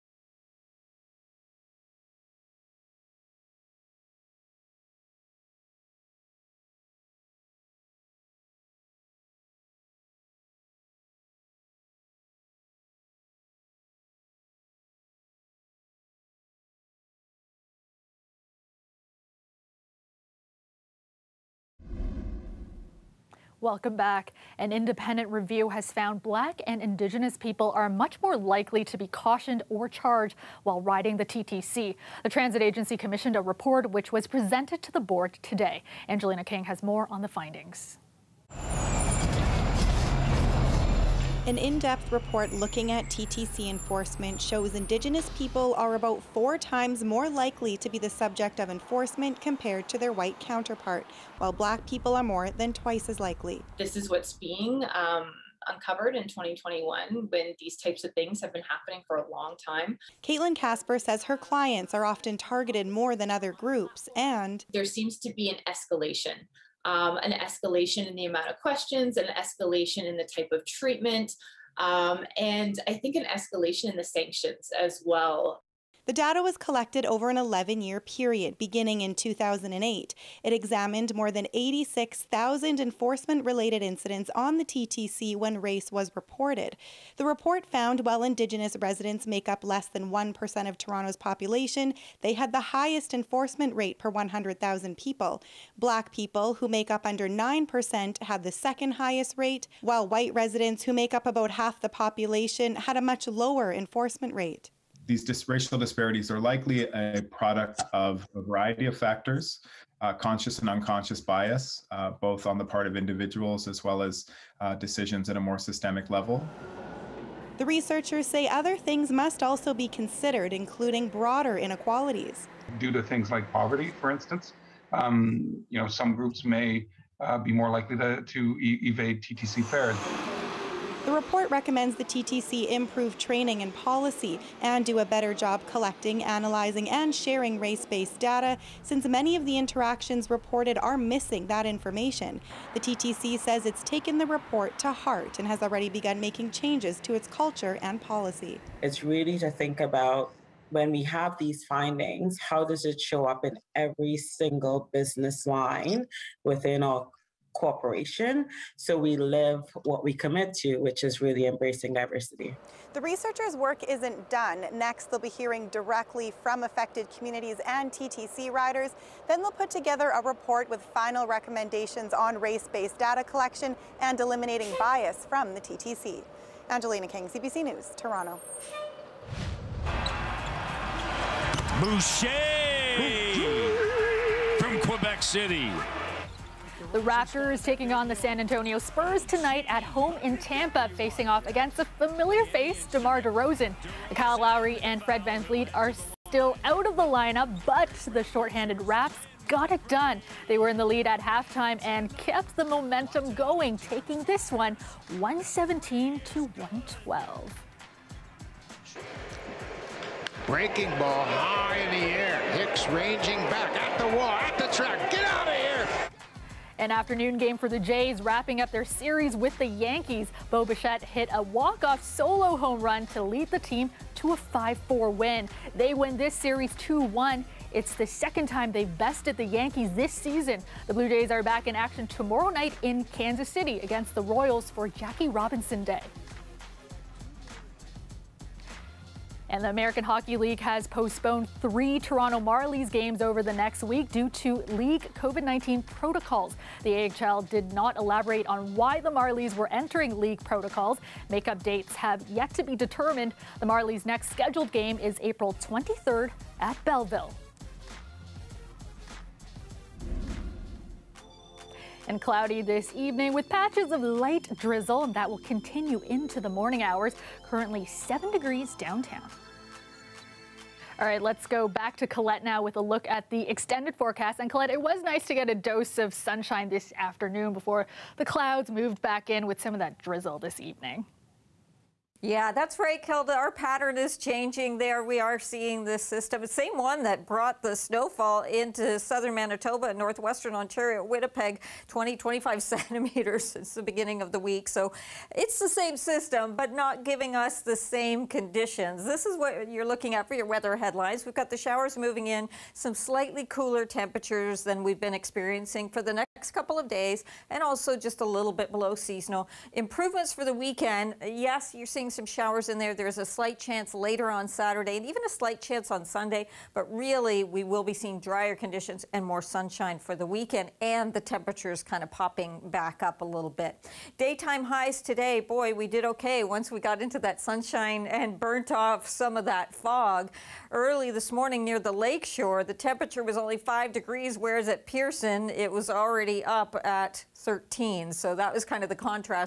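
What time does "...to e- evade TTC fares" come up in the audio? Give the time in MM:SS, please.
02:08.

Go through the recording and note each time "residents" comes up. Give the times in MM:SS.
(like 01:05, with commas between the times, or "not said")
01:28, 01:40.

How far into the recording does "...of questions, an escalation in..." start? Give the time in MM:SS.
01:08.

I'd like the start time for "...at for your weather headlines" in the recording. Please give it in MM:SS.
05:00.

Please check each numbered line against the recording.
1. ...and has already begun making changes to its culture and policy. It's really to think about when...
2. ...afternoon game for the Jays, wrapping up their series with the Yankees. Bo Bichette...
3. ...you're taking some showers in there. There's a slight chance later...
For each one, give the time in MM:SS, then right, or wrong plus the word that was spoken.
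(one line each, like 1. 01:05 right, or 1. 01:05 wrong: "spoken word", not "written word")
1. 02:25 right
2. 03:36 right
3. 05:11 wrong: "seeing", not "taking".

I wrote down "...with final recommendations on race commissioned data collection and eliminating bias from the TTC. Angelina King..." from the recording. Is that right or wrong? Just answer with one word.
wrong.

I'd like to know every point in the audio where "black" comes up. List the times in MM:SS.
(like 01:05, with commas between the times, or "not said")
00:26, 00:51, 01:35.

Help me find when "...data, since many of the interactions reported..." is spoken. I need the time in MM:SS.
02:18.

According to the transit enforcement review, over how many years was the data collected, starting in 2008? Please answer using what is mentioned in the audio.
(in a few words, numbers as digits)
11.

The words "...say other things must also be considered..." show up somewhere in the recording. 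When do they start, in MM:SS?
01:58.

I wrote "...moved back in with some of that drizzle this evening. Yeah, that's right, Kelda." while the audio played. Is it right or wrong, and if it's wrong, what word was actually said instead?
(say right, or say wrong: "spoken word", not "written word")
right.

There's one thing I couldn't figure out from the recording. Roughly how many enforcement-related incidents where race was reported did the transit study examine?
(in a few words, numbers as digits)
86,000.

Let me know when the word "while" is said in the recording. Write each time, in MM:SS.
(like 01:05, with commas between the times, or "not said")
00:30, 00:51, 01:28, 01:39.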